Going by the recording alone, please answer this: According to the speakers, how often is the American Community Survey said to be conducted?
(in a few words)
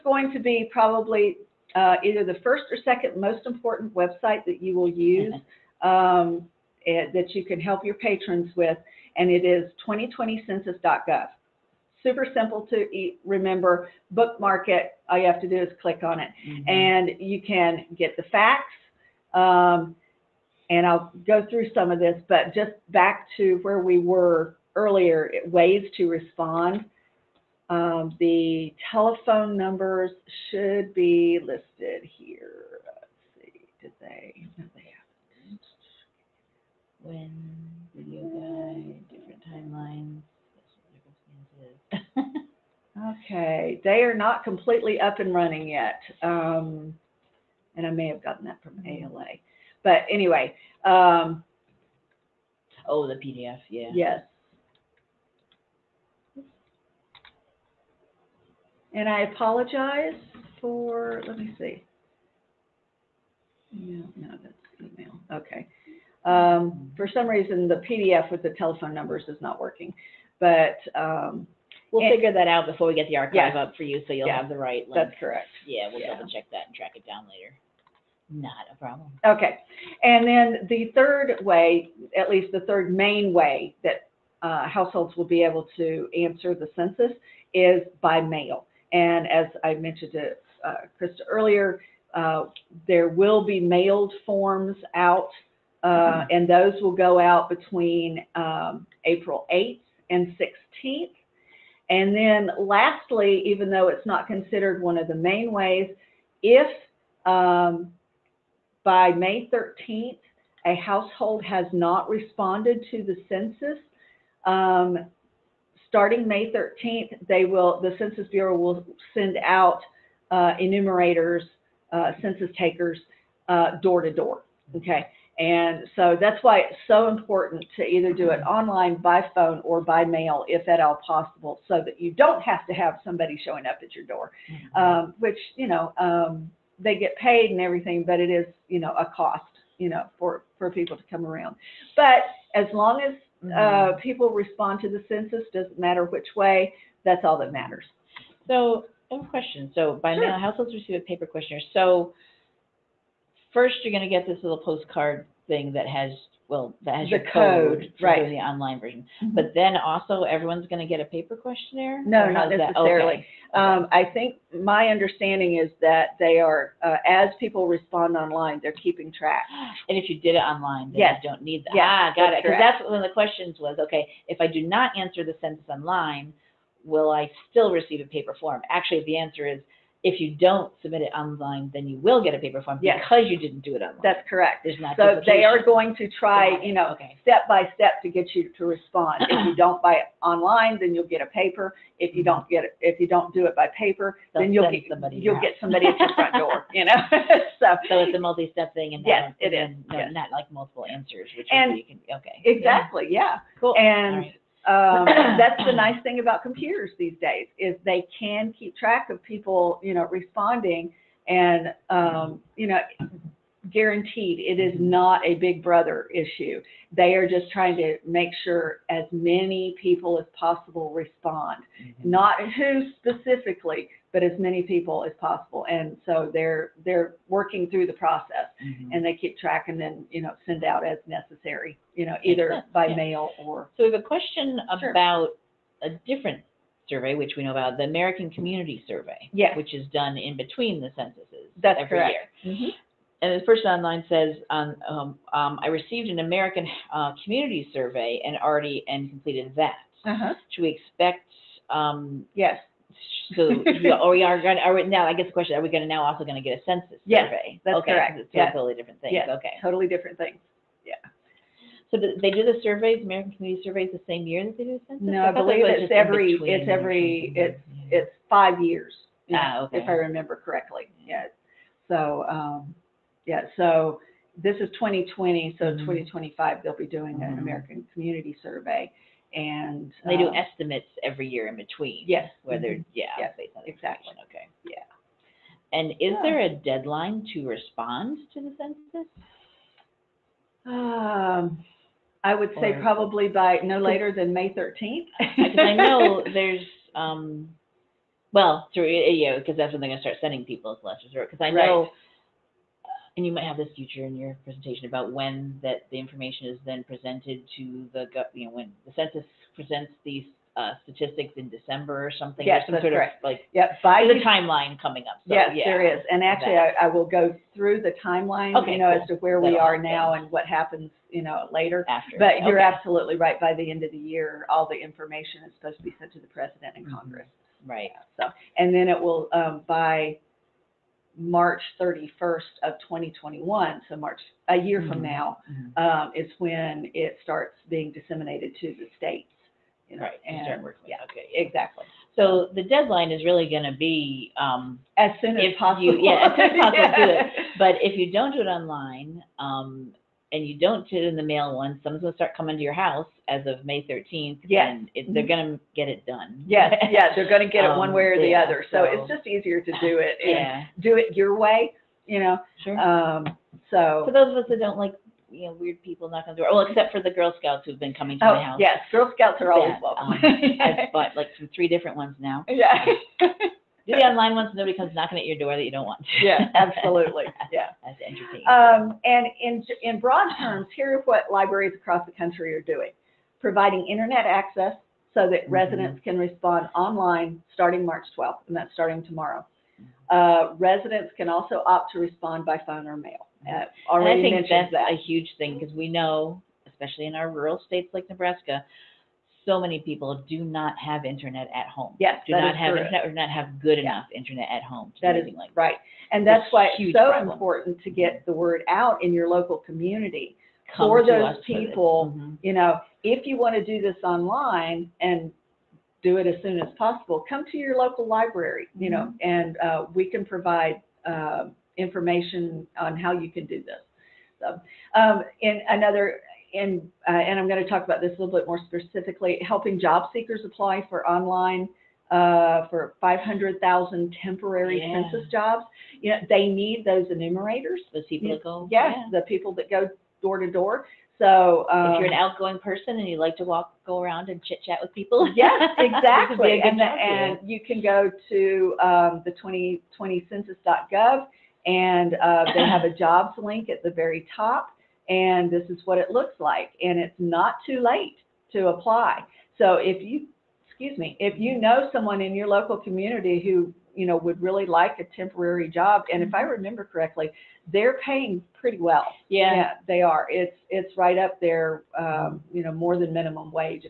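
Five years.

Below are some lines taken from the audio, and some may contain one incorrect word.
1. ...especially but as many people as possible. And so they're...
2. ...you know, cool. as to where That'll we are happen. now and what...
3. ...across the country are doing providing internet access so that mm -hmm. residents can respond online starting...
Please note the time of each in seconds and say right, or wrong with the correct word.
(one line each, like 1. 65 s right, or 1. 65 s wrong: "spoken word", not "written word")
1. 222 s wrong: "specifically", not "especially"
2. 318 s right
3. 381 s right.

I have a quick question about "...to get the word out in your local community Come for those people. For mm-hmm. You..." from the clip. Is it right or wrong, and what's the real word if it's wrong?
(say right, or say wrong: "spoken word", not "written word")
right.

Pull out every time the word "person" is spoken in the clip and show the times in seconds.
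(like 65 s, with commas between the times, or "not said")
243 s, 442 s.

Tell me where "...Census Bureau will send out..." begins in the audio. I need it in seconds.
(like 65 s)
117 s.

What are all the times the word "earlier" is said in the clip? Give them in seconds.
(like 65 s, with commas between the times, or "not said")
24 s, 91 s.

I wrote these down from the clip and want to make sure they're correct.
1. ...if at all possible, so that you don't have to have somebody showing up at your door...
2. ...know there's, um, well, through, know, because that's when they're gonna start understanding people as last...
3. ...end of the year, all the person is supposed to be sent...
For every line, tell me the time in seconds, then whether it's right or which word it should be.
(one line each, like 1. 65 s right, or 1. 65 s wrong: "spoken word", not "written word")
1. 130 s right
2. 295 s wrong: "sending", not "understanding"
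3. 323 s wrong: "information", not "person".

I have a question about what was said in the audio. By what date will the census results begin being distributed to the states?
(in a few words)
March 31st of 2021.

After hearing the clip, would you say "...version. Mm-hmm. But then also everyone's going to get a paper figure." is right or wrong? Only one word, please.
wrong.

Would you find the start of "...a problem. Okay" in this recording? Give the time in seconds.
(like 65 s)
78 s.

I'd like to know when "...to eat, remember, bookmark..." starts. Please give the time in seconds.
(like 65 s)
12 s.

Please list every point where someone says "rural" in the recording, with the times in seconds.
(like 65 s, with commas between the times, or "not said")
397 s.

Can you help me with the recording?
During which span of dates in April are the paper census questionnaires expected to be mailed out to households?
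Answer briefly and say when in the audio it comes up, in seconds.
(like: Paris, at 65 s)
April 8th and 16th, at 99 s.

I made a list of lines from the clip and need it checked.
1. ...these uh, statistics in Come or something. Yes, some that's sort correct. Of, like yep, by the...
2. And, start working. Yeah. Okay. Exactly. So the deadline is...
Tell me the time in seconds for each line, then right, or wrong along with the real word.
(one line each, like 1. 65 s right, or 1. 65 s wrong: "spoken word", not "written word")
1. 310 s wrong: "December", not "Come"
2. 340 s right.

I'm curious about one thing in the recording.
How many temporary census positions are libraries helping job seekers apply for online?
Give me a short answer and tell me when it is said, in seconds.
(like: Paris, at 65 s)
500,000, at 433 s.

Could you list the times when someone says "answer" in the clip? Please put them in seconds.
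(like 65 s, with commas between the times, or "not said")
86 s, 174 s, 179 s, 200 s.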